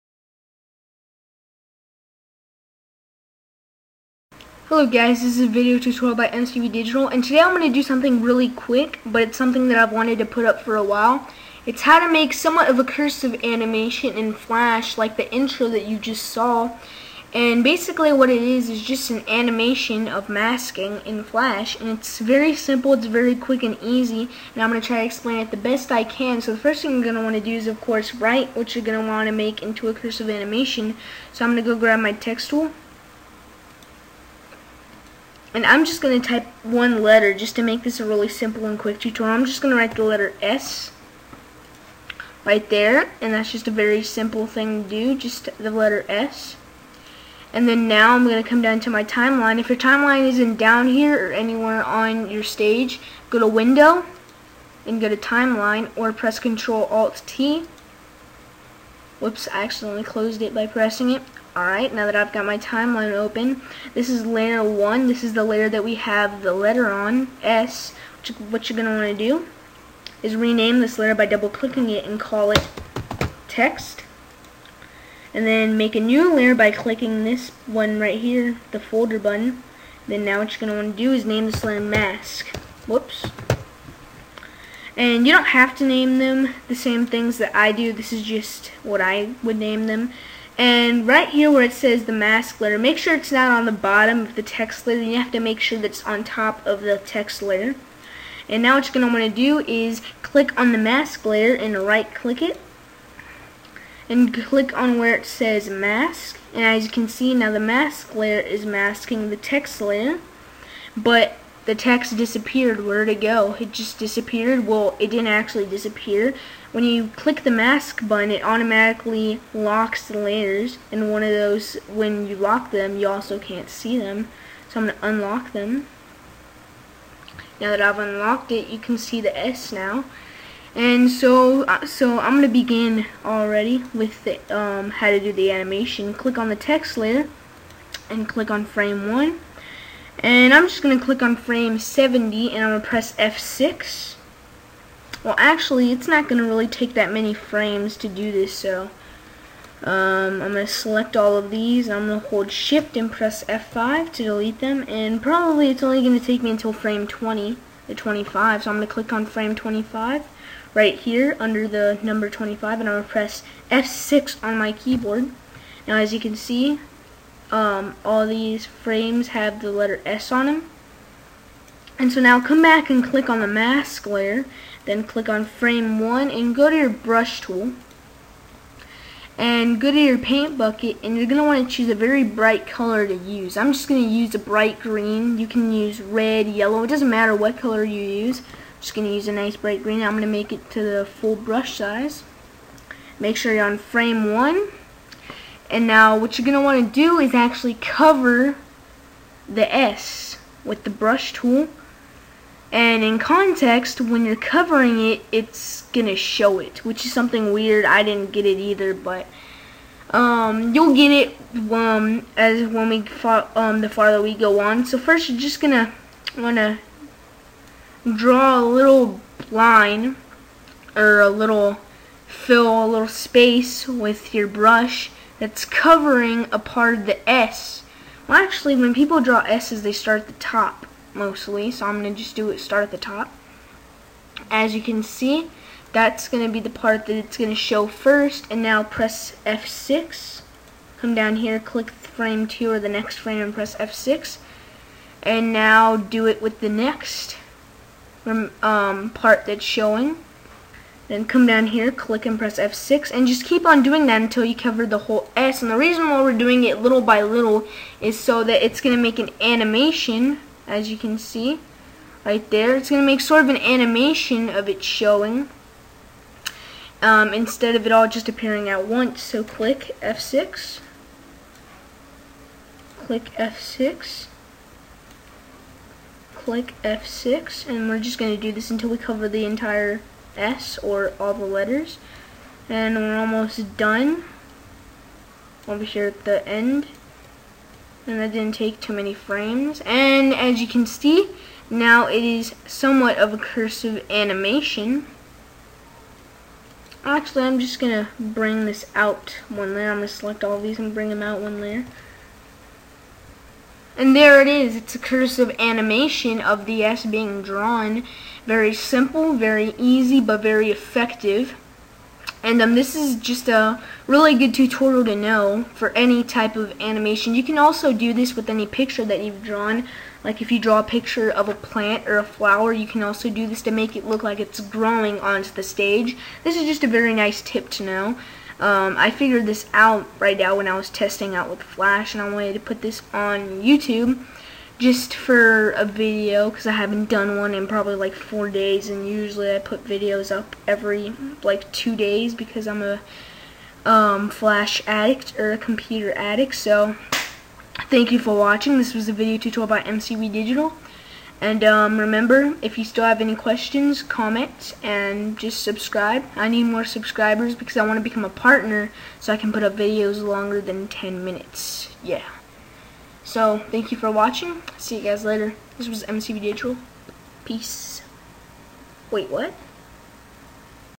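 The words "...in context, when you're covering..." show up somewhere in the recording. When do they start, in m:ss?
3:23.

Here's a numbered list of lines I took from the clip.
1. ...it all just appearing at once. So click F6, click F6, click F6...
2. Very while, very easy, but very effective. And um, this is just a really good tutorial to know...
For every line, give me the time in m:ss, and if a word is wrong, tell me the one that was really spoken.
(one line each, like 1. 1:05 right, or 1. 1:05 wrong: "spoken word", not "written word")
1. 4:27 right
2. 5:08 wrong: "simple", not "while".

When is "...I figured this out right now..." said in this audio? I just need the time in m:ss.
5:28.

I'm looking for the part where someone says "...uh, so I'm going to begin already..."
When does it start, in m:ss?
2:11.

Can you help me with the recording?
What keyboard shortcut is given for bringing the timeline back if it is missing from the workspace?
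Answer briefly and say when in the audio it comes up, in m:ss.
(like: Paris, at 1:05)
Control Alt T, at 0:56.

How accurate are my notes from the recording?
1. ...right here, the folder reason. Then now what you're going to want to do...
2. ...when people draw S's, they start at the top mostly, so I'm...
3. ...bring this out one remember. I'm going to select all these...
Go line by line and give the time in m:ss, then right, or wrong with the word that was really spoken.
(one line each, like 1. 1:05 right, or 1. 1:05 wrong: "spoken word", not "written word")
1. 1:17 wrong: "button", not "reason"
2. 3:48 right
3. 4:58 wrong: "layer", not "remember".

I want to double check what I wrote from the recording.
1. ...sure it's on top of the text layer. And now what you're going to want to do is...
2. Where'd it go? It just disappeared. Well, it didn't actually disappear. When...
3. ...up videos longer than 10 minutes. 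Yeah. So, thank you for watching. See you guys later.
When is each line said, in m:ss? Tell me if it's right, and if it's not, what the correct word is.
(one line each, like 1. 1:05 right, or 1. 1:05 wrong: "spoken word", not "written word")
1. 1:35 right
2. 1:52 right
3. 5:59 right.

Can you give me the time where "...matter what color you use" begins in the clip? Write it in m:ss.
3:07.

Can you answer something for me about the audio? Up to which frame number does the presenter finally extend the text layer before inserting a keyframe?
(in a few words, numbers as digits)
25.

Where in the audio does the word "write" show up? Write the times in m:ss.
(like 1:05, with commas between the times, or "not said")
0:28, 0:39.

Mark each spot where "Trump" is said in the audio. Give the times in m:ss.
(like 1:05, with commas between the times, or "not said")
not said.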